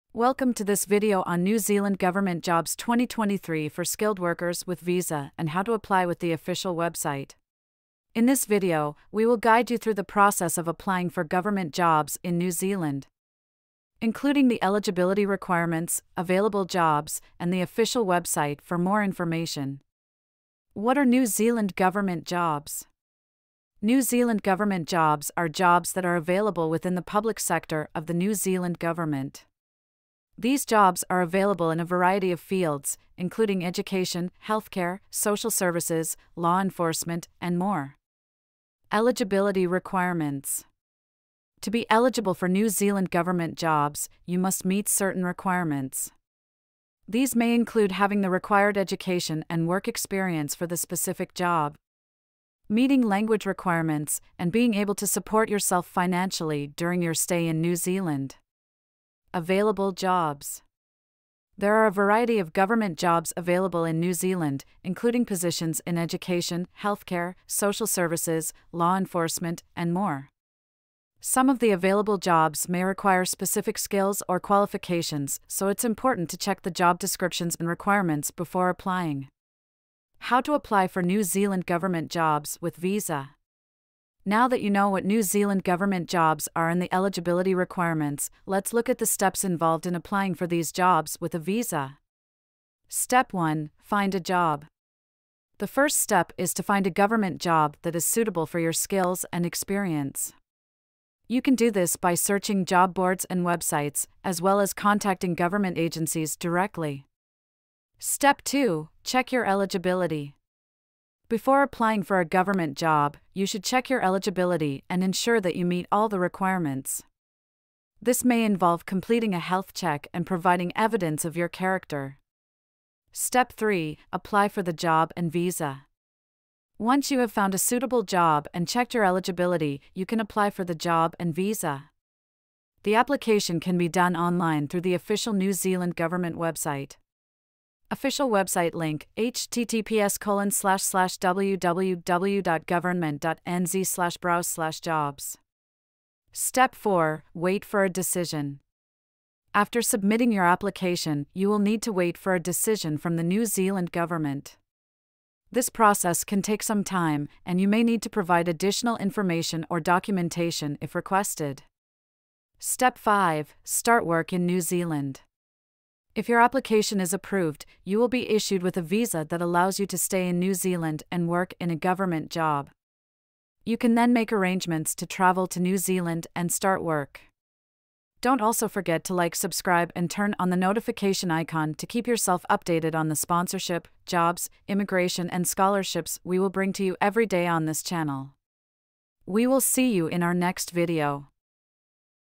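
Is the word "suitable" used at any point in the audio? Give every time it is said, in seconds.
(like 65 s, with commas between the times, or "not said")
98 s, 127 s.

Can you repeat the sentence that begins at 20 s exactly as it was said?
What are New Zealand government jobs?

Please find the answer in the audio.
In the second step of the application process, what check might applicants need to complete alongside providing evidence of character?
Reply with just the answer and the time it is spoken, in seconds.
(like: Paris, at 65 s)
Health check, at 119 s.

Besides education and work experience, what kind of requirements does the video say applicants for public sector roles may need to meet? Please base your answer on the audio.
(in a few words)
Language requirements.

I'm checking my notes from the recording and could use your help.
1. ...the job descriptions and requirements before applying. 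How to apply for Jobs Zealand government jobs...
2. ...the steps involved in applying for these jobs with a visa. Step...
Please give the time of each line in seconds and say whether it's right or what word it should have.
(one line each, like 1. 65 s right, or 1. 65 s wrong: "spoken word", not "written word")
1. 76 s wrong: "New", not "Jobs"
2. 88 s right.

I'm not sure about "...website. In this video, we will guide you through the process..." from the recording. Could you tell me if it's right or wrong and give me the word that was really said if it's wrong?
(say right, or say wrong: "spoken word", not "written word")
right.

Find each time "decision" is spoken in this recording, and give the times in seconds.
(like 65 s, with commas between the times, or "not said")
147 s, 152 s.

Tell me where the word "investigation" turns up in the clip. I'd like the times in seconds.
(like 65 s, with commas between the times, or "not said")
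not said.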